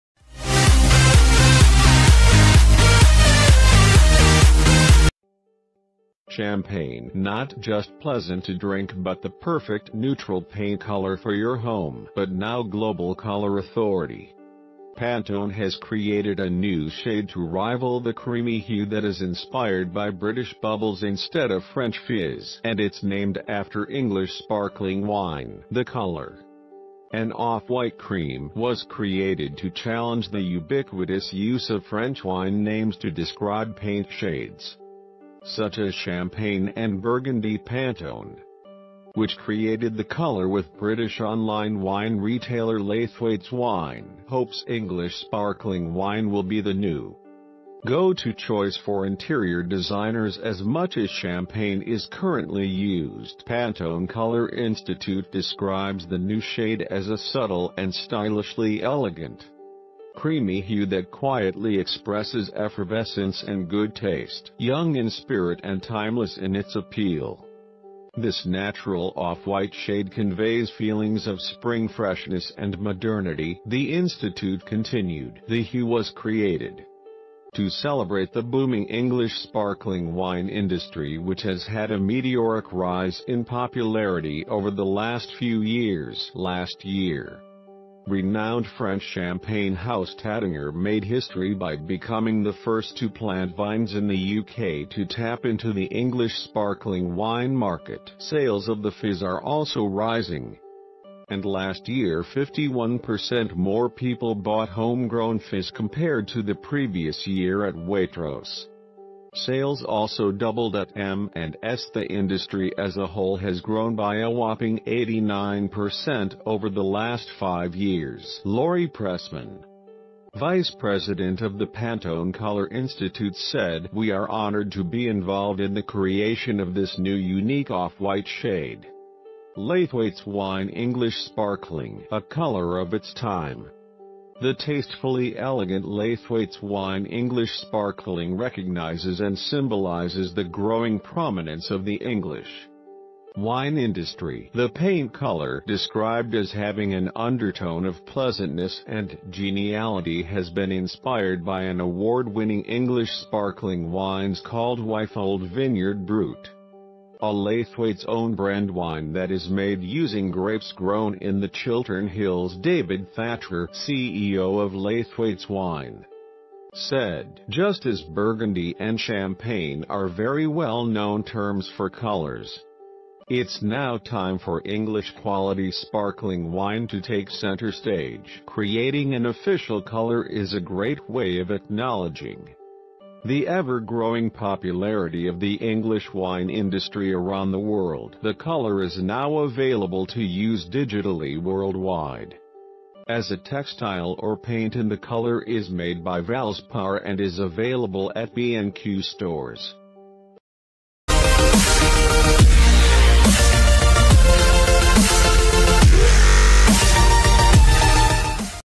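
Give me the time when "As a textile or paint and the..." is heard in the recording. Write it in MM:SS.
03:13.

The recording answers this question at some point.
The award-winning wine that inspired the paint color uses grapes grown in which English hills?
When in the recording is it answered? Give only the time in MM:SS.
02:41.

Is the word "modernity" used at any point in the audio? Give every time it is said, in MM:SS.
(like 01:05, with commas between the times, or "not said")
01:12.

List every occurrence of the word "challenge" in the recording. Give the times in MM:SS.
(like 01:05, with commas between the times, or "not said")
00:29.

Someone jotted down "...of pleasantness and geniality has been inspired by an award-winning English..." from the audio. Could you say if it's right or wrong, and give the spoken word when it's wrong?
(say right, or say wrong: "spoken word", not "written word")
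right.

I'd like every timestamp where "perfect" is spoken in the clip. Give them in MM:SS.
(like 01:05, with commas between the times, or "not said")
00:09.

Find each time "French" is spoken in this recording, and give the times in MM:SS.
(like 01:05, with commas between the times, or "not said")
00:21, 00:31, 01:28.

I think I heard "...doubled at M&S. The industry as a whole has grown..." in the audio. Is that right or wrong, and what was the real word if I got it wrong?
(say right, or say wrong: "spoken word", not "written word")
right.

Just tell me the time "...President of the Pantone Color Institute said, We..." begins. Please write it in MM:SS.
02:00.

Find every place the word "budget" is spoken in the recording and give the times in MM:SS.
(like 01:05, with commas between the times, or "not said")
not said.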